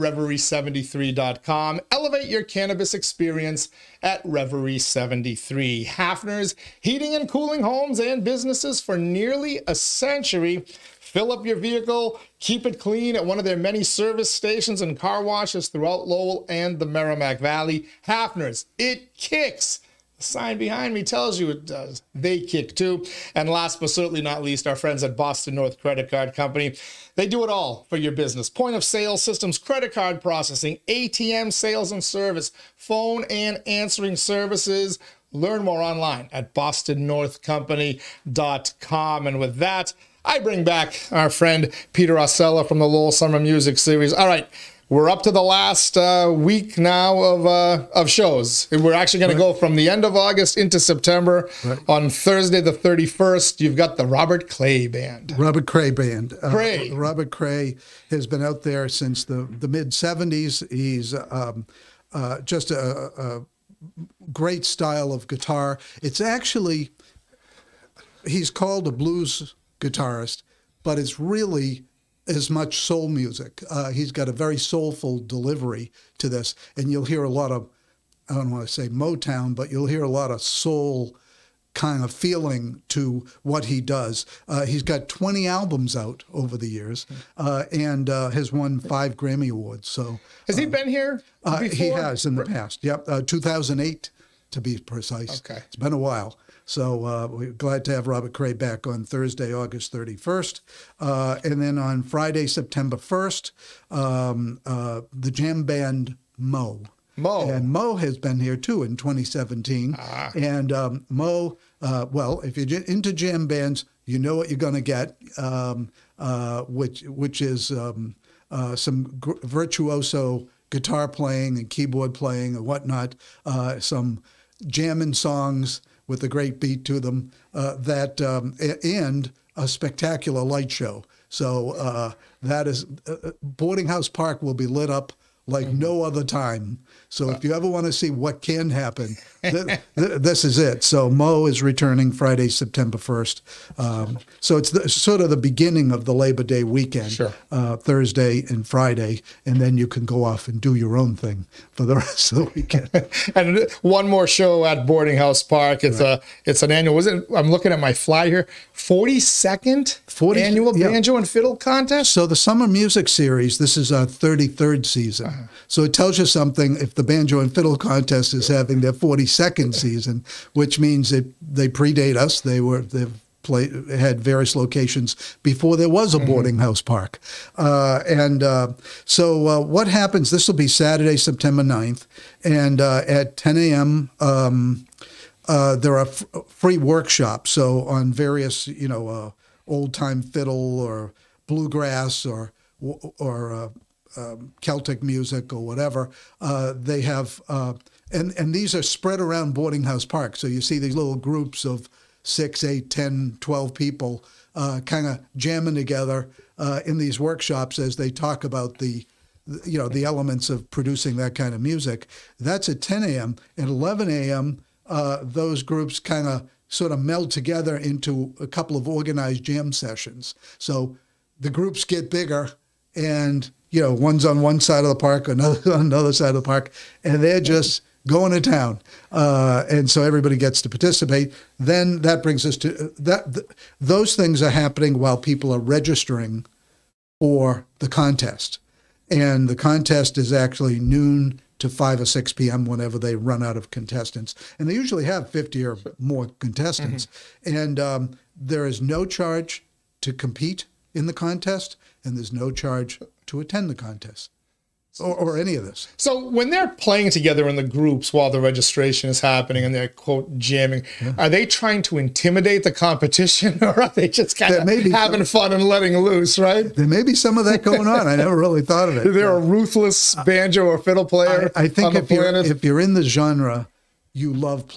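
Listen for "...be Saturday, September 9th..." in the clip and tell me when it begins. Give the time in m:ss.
3:00.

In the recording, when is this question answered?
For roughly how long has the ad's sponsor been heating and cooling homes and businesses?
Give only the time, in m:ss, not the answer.
0:08.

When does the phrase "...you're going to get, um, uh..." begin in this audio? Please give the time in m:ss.
1:54.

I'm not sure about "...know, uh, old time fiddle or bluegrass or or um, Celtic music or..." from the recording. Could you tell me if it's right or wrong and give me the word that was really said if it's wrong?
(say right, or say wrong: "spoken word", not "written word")
right.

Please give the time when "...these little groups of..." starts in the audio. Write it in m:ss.
3:20.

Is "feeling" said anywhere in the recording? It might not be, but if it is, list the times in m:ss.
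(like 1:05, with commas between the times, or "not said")
1:22.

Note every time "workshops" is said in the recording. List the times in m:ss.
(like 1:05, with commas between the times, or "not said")
3:06, 3:27.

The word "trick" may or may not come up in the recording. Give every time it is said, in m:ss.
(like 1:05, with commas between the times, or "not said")
not said.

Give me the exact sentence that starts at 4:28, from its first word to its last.
I never really thought of it.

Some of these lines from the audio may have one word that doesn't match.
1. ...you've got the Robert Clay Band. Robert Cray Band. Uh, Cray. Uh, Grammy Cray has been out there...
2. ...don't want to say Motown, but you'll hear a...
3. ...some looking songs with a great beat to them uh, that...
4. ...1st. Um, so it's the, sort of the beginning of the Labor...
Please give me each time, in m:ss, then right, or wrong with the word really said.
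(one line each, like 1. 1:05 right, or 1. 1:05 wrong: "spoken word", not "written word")
1. 0:53 wrong: "Robert", not "Grammy"
2. 1:18 right
3. 2:03 wrong: "jamming", not "looking"
4. 2:22 right.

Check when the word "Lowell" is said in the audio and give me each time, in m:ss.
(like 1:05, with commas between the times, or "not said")
0:16, 0:42.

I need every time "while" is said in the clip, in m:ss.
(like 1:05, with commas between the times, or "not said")
1:35, 3:54, 4:18.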